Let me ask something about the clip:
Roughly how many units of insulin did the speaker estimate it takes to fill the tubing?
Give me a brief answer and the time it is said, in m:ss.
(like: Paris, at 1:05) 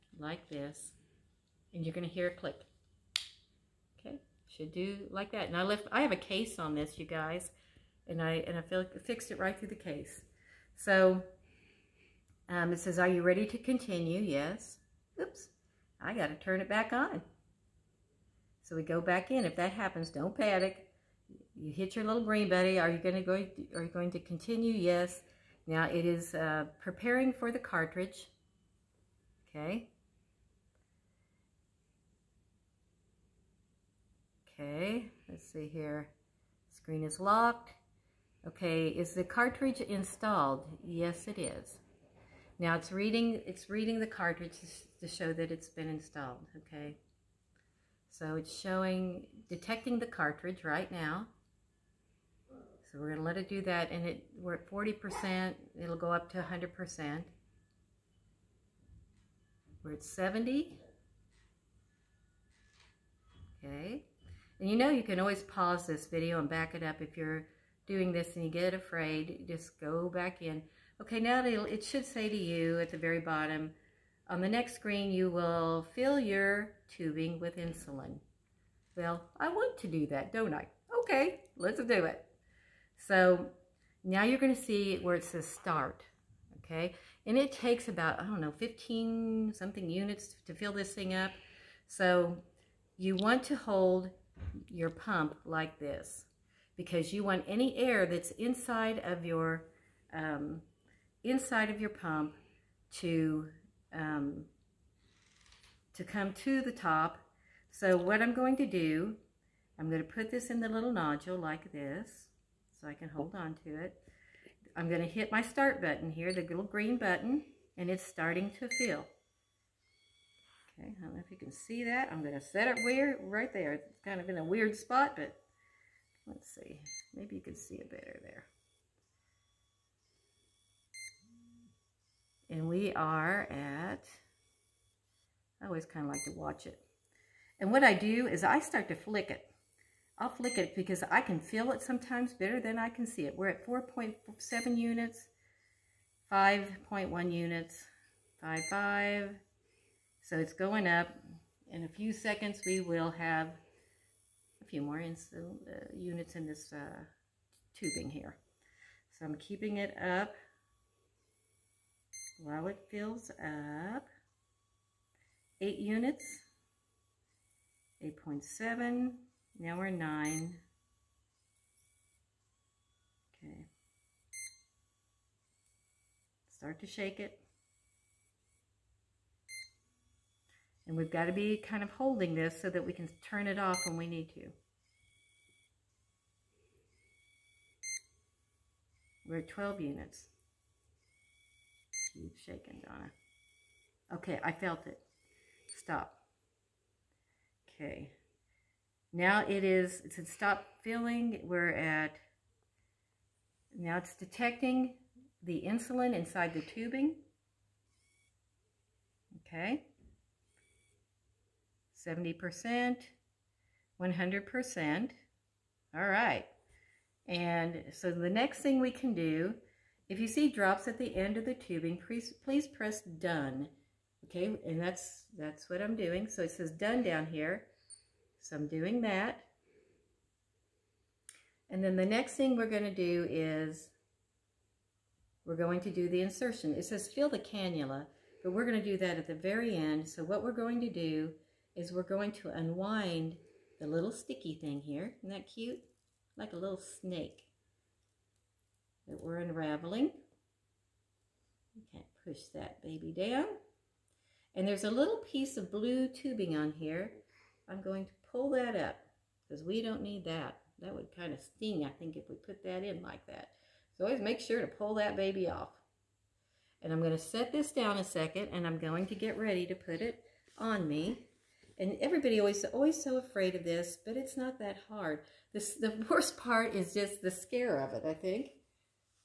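15 units, at 1:28.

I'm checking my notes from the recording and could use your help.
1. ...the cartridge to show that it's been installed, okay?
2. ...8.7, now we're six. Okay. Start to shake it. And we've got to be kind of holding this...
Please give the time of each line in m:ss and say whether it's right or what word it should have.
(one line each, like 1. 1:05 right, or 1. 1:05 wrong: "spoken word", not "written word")
1. 0:43 right
2. 2:48 wrong: "nine", not "six".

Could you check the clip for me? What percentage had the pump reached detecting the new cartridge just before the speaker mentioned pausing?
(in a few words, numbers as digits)
70%.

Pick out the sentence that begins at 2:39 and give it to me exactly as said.
So I'm keeping it up while it fills up.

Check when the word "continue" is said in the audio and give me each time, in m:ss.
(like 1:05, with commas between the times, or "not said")
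0:13, 0:24.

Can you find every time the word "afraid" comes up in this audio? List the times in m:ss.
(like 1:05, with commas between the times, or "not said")
1:08, 4:33.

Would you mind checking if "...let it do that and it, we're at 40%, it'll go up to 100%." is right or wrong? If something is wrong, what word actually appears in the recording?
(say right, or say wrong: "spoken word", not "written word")
right.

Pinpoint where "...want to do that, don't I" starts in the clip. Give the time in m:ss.
1:19.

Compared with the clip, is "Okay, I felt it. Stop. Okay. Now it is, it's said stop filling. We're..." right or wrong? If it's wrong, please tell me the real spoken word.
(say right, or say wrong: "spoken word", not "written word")
right.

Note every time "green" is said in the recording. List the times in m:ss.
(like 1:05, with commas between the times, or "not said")
0:22, 1:56.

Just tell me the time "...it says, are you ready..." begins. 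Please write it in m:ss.
0:12.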